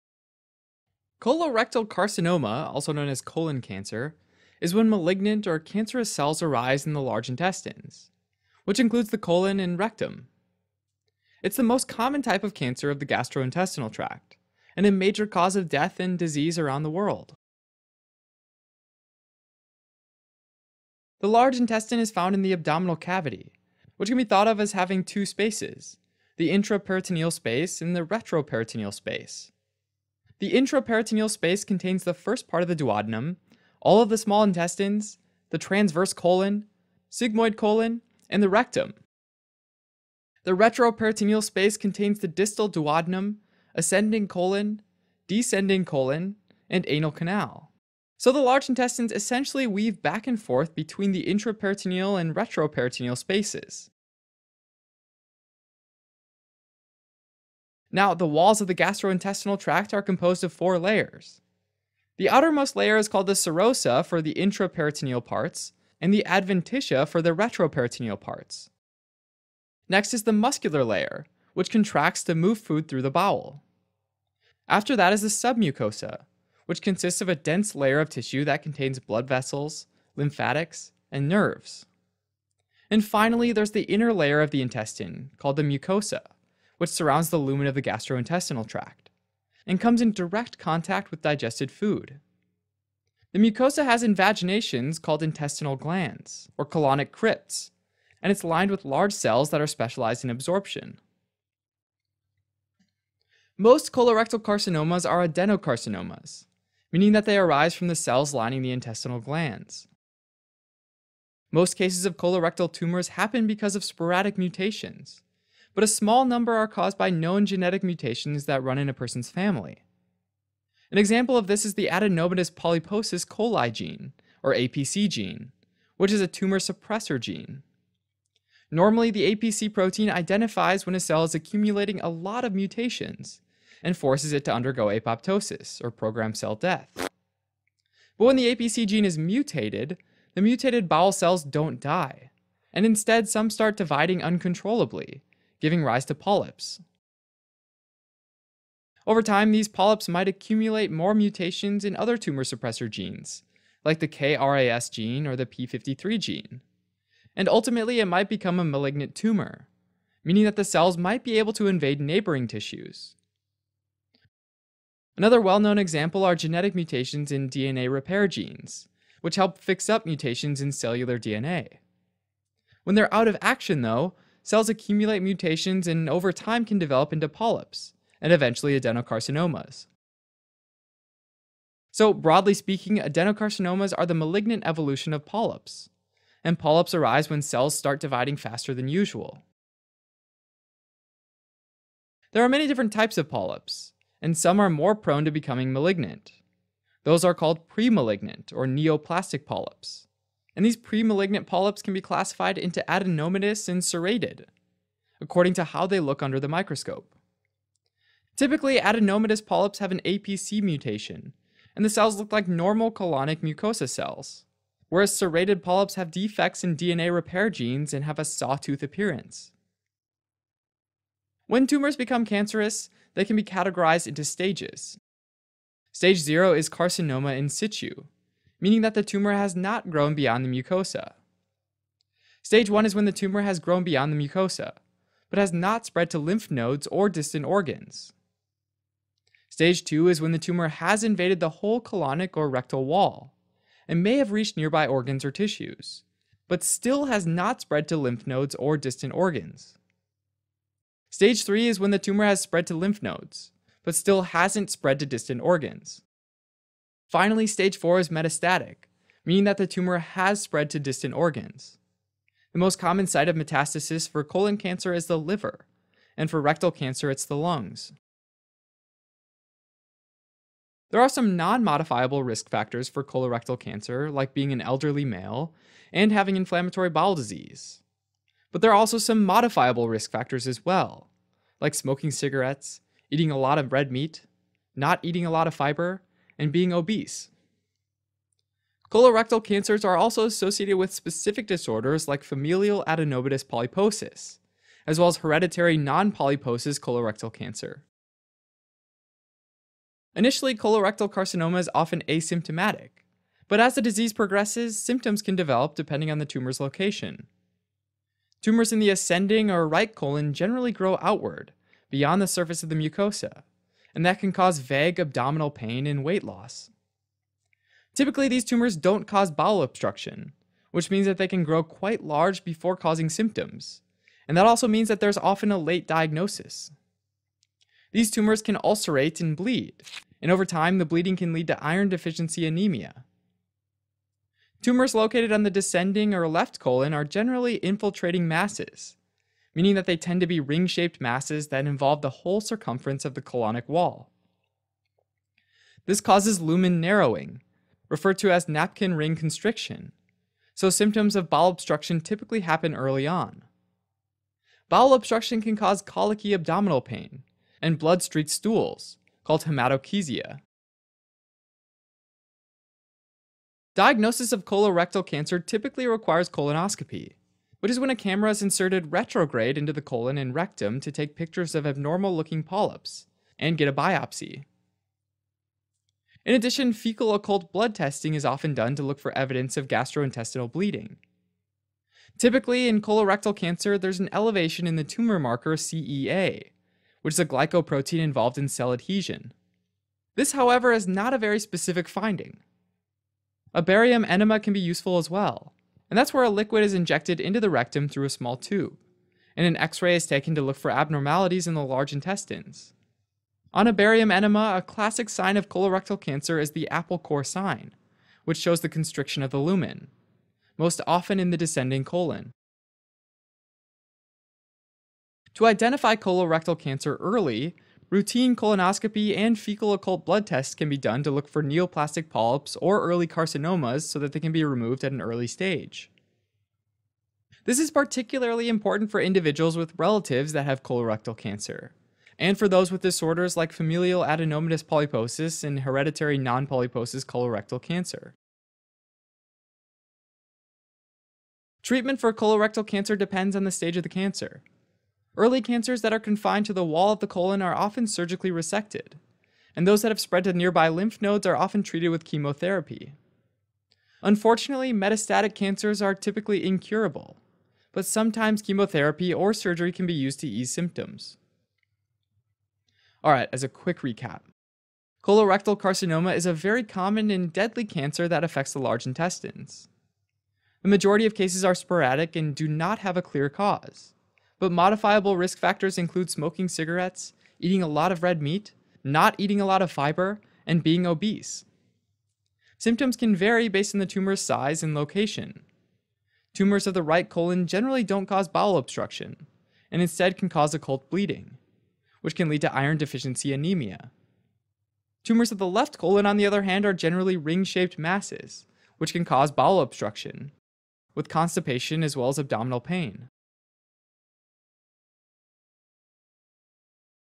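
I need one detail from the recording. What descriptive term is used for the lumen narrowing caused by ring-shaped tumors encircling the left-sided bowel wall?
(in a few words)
napkin ring constriction.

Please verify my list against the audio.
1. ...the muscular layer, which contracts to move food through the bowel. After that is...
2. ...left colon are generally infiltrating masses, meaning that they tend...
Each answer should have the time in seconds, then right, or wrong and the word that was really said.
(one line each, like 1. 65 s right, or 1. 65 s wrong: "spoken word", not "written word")
1. 70 s right
2. 336 s right.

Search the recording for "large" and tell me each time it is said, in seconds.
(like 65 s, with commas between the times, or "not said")
7 s, 21 s, 48 s, 98 s, 322 s, 401 s, 468 s.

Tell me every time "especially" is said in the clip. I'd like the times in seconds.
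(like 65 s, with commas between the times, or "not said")
not said.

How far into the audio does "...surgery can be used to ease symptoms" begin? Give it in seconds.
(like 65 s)
459 s.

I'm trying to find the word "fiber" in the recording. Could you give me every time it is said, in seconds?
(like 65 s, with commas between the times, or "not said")
285 s, 479 s.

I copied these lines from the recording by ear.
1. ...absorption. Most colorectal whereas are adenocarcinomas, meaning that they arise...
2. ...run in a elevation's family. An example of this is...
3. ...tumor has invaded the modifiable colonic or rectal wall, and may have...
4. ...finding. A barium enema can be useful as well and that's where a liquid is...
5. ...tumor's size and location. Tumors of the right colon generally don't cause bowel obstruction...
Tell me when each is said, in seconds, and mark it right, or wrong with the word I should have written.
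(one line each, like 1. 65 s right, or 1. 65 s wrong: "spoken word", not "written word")
1. 100 s wrong: "carcinomas", not "whereas"
2. 118 s wrong: "person", not "elevation"
3. 240 s wrong: "whole", not "modifiable"
4. 391 s right
5. 483 s right.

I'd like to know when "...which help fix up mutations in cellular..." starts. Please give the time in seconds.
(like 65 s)
169 s.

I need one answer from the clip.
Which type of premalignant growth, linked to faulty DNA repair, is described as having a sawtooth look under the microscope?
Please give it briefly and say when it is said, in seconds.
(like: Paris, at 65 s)
serrated polyps, at 215 s.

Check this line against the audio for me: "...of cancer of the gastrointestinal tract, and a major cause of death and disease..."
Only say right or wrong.
right.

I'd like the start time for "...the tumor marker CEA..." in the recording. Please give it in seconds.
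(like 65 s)
384 s.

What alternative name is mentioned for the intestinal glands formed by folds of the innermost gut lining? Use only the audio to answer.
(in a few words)
colonic crypts.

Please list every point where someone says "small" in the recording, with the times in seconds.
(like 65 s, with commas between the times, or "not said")
34 s, 115 s, 398 s.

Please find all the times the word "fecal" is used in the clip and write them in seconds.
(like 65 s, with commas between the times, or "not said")
376 s, 419 s.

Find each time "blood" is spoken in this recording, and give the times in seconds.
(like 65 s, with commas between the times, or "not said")
78 s, 357 s, 377 s, 420 s.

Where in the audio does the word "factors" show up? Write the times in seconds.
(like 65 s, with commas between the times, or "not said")
272 s, 280 s, 475 s.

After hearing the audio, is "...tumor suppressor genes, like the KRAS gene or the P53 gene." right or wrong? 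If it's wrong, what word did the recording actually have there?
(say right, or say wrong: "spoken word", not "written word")
right.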